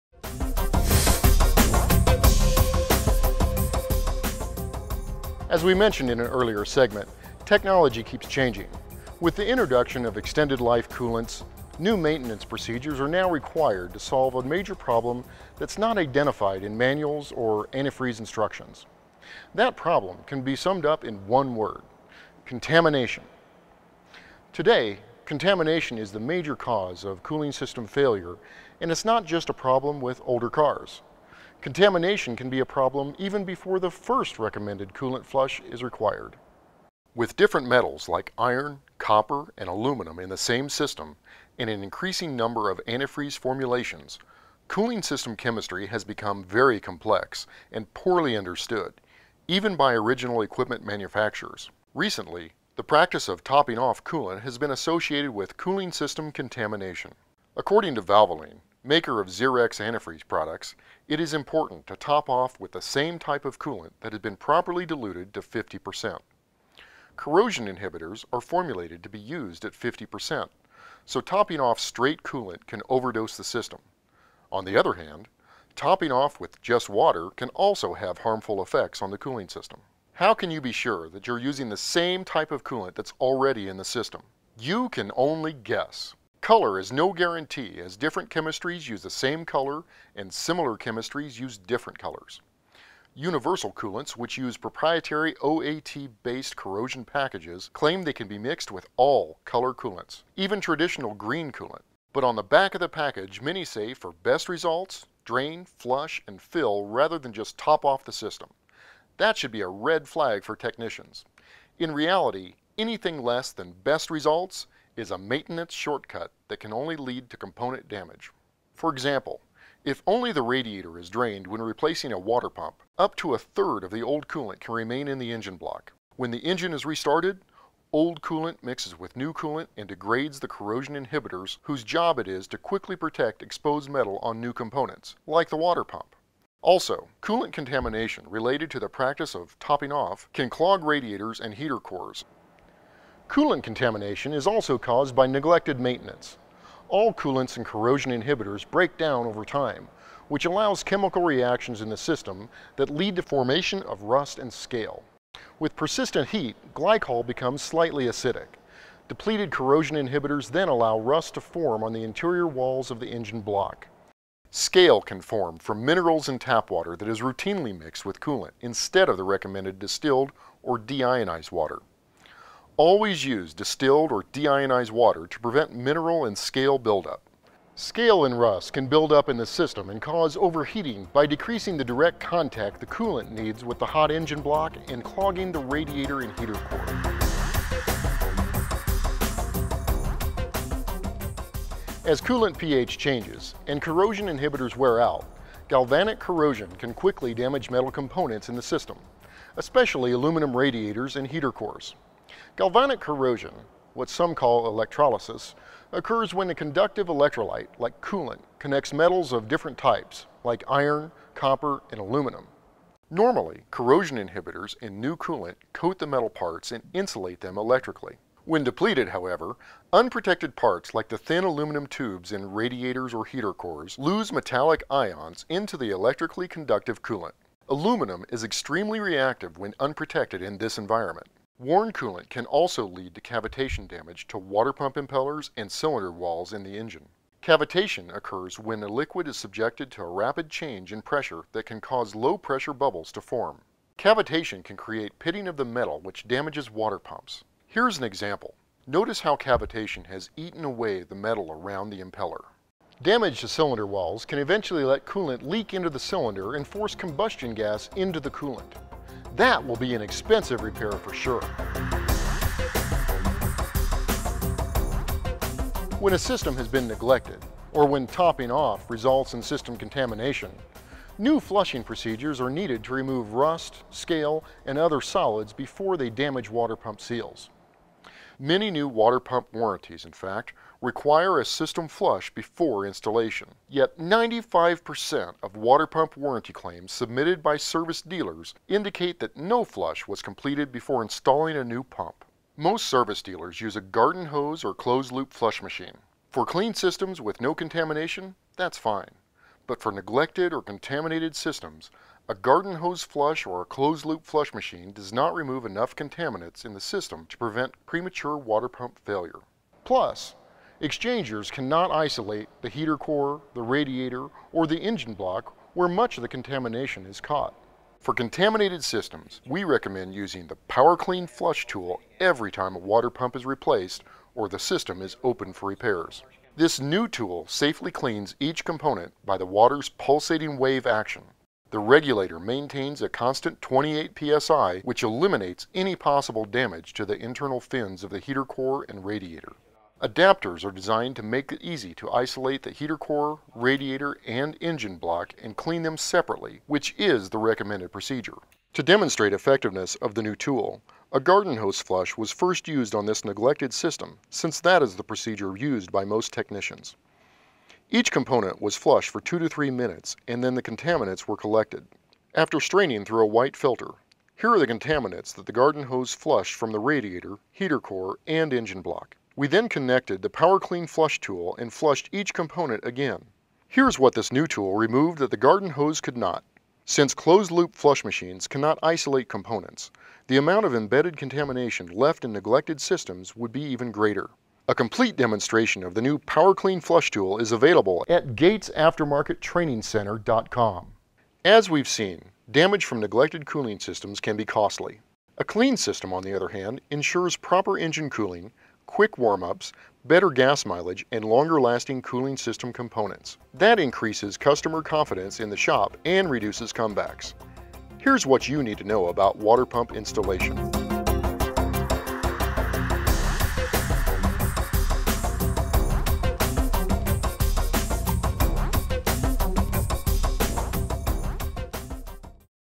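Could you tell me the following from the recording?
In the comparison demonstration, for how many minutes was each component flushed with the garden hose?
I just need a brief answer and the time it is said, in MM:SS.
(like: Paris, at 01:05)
2 to 3 minutes, at 05:59.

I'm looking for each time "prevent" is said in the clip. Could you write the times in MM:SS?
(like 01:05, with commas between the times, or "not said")
02:55, 05:07.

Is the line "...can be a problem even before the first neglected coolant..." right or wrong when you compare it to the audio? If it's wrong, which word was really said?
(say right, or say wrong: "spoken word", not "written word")
wrong: "recommended", not "neglected".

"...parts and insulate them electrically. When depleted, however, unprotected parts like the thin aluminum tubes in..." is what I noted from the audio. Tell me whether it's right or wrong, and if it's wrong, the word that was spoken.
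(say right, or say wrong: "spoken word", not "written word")
right.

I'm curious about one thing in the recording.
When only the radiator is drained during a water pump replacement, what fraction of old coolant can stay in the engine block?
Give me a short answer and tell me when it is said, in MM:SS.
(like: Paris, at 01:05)
a third, at 02:03.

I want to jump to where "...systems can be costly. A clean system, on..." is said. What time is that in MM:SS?
06:33.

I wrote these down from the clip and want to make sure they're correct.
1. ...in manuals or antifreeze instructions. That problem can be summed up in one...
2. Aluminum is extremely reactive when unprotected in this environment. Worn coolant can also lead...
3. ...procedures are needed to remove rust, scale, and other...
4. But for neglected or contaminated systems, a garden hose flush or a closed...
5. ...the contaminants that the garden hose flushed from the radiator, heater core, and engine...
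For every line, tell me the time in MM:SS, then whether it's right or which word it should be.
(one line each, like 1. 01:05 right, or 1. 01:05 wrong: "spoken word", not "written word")
1. 00:16 right
2. 03:47 right
3. 04:31 right
4. 04:59 right
5. 06:04 right.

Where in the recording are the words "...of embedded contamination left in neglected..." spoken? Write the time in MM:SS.
06:20.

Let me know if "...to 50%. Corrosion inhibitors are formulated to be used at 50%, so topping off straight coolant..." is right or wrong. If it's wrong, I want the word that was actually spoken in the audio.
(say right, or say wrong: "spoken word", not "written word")
right.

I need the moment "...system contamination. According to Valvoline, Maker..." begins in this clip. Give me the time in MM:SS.
00:55.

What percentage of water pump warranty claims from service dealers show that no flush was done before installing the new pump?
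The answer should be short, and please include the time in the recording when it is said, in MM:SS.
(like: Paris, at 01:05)
95%, at 04:43.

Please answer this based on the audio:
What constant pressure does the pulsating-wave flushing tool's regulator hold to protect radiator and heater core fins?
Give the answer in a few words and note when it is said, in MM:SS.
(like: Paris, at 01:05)
28 psi, at 05:33.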